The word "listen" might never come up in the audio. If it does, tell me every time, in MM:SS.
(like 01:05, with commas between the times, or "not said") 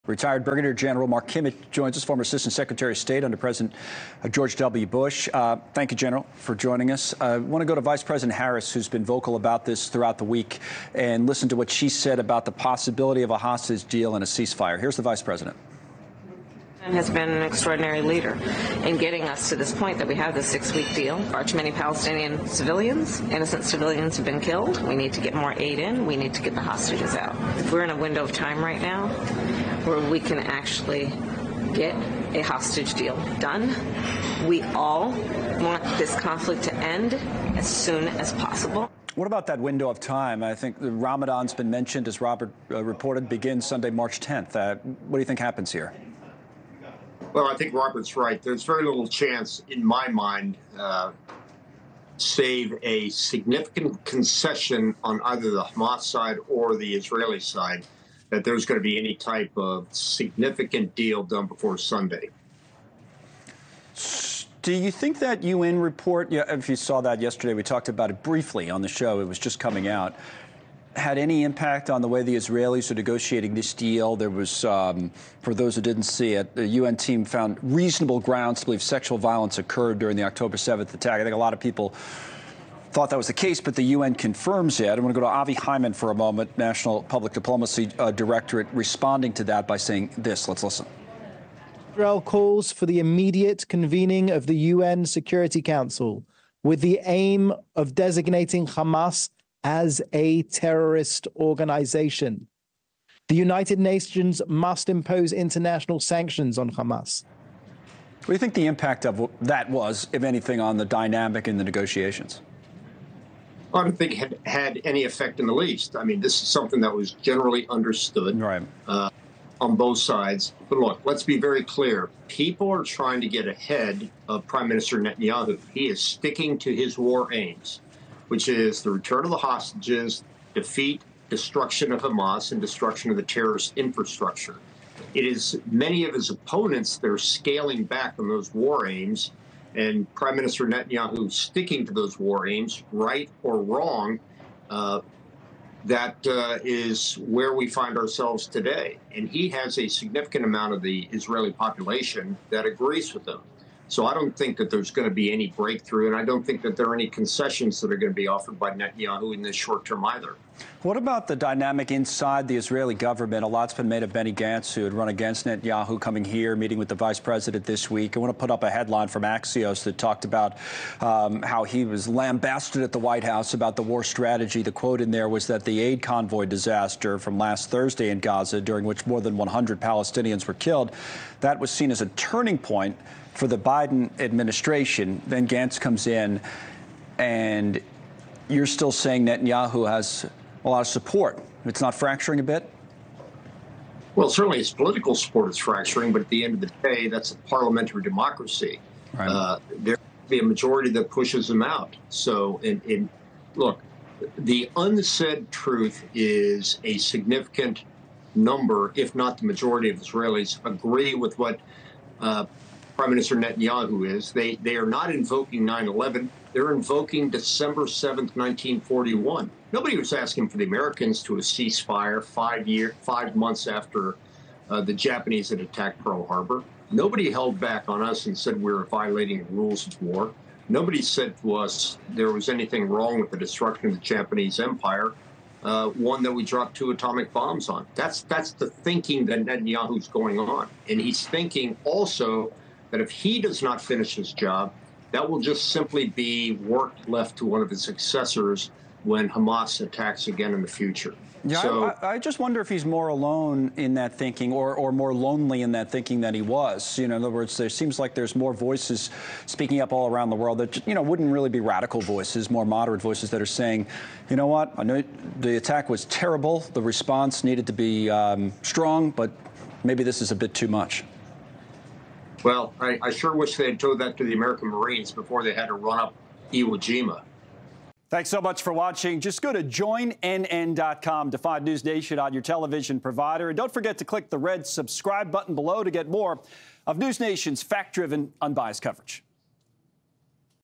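00:11, 01:30.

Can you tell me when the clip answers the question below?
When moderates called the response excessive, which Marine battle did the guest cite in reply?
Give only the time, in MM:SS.
04:36.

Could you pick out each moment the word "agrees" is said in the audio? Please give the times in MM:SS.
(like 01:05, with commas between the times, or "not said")
02:32, 03:30.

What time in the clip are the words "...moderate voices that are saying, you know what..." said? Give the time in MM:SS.
04:22.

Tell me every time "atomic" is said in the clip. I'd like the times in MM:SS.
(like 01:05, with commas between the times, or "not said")
03:56.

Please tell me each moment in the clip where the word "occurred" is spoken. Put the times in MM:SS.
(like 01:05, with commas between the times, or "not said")
01:19.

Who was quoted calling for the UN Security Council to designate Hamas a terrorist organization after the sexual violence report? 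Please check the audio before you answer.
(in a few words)
Avi Hyman.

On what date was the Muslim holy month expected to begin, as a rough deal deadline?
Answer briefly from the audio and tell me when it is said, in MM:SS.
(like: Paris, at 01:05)
Sunday, March 10th, at 00:43.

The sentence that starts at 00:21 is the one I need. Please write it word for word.
Far too many Palestinian civilians, innocent civilians have been killed.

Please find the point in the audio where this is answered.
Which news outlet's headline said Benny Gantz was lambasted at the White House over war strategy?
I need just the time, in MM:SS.
02:49.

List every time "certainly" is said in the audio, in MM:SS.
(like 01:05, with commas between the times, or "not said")
03:14.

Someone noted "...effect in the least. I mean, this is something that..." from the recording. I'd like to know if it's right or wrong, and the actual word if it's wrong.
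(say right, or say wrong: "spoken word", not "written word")
right.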